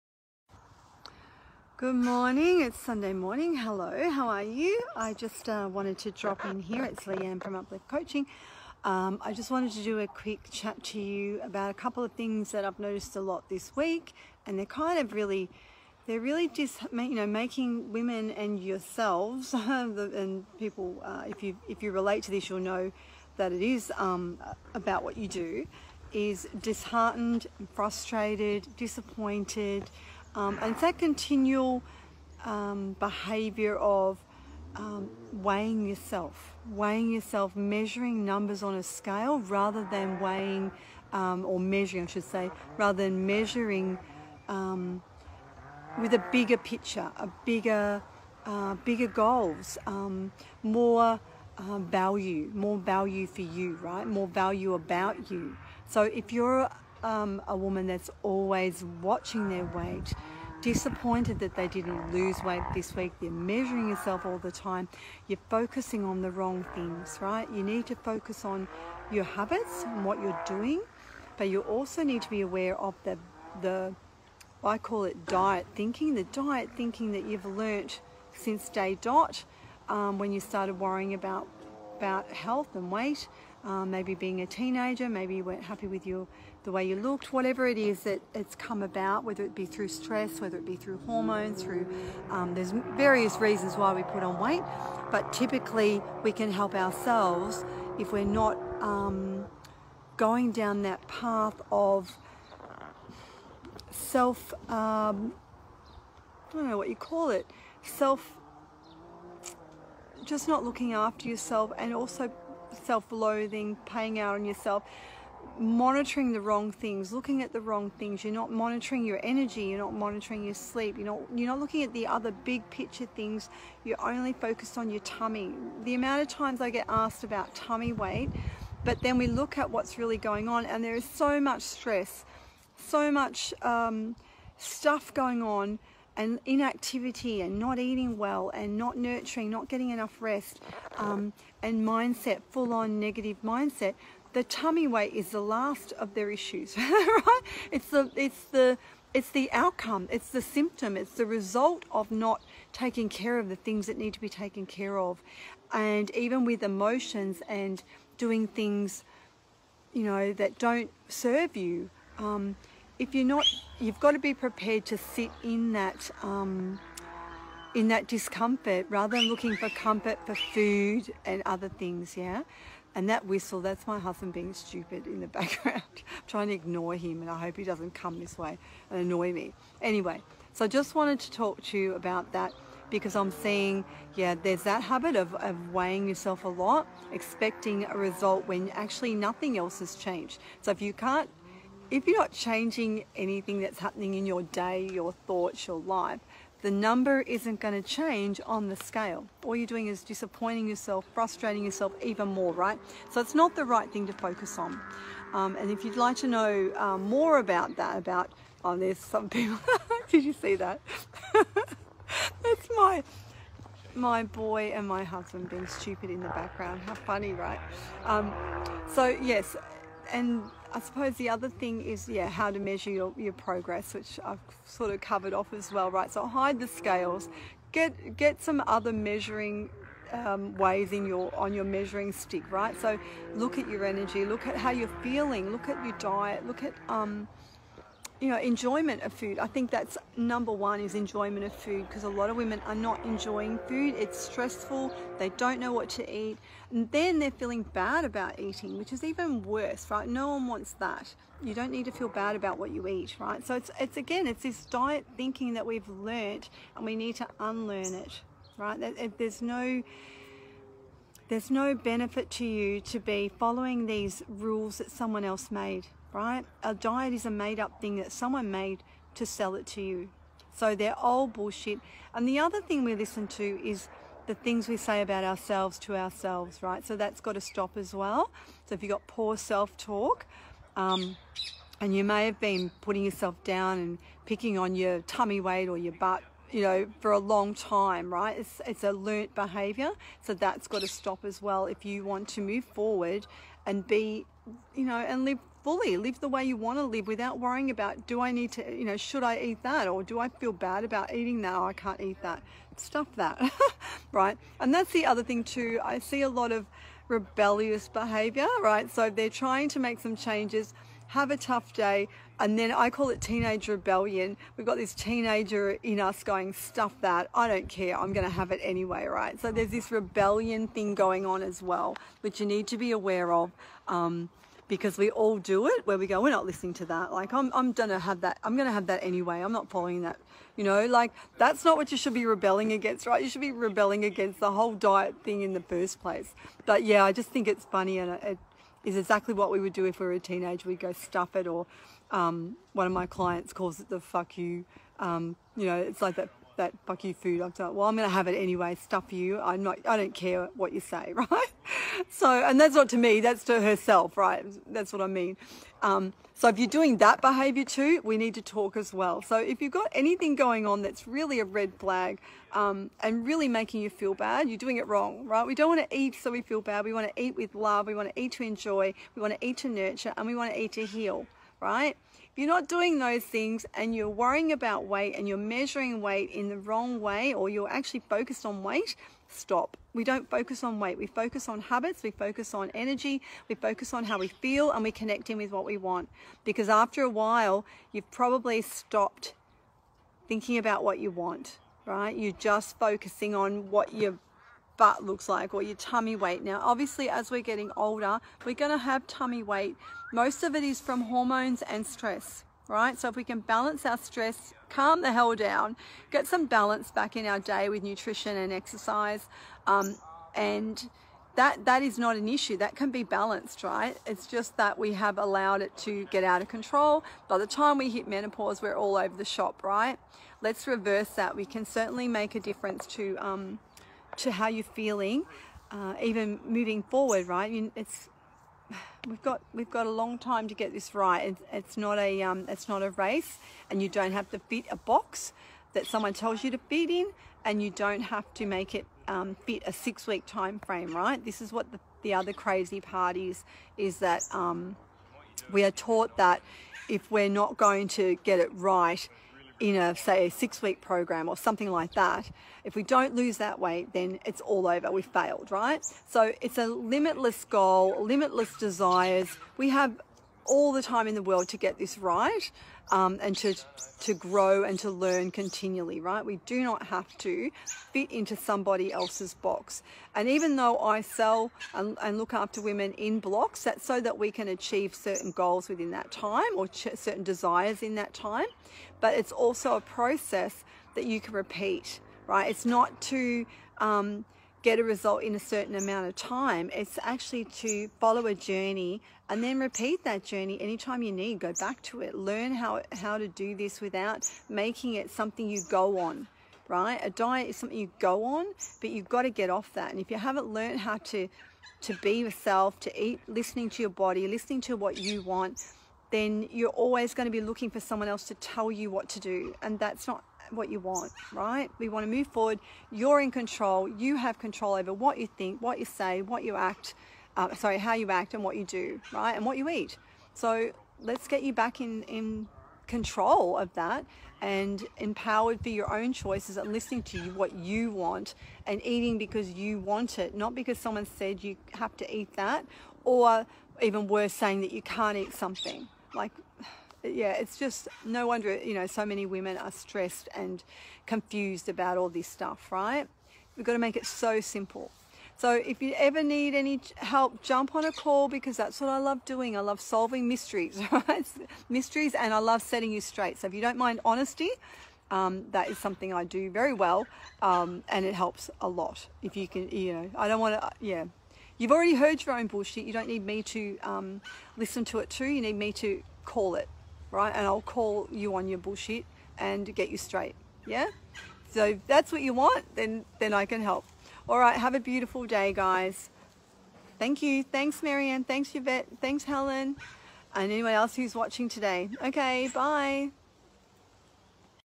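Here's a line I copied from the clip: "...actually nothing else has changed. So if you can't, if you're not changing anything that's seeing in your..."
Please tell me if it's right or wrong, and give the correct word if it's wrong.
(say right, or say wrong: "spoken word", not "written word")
wrong: "happening", not "seeing".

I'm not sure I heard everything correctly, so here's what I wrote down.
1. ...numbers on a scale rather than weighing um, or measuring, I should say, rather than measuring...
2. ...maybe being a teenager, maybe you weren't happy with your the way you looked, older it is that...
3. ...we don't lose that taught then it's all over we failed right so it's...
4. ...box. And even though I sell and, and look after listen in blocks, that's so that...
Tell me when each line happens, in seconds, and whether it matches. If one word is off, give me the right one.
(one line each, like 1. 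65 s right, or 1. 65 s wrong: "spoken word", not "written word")
1. 38 s right
2. 83 s wrong: "whatever", not "older"
3. 452 s wrong: "weight", not "taught"
4. 469 s wrong: "women", not "listen".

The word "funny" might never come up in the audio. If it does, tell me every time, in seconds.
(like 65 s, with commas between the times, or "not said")
216 s, 337 s.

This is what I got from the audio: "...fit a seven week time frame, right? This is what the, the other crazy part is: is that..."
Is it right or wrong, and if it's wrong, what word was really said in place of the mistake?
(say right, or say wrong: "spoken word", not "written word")
wrong: "six", not "seven".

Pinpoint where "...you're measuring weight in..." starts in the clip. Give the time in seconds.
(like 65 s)
375 s.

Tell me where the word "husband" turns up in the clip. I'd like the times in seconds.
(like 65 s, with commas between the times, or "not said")
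173 s, 215 s.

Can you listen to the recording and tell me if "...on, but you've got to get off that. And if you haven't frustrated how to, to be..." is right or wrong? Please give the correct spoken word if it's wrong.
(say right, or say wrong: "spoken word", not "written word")
wrong: "learned", not "frustrated".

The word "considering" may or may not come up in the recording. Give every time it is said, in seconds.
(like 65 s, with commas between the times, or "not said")
not said.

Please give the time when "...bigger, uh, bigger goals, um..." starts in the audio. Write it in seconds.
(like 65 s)
47 s.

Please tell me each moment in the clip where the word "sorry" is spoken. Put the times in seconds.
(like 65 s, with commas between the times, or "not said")
517 s.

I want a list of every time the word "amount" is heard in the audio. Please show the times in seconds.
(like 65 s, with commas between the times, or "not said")
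125 s, 485 s.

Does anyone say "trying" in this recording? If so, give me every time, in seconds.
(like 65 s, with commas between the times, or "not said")
176 s, 309 s.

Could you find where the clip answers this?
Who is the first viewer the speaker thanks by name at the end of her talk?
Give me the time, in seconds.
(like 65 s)
577 s.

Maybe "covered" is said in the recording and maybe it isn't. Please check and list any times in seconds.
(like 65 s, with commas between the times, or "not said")
225 s.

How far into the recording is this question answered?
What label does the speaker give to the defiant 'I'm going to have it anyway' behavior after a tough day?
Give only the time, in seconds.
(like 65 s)
313 s.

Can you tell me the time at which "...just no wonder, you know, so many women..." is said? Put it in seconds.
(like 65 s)
537 s.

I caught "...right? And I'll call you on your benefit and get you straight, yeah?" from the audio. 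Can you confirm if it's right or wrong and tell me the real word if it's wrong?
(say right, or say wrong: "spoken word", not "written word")
wrong: "bullshit", not "benefit".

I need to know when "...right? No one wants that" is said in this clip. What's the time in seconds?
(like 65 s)
249 s.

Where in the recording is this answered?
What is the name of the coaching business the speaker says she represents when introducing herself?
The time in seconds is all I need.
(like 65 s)
7 s.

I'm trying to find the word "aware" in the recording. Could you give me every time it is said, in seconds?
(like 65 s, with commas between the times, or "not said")
72 s, 322 s.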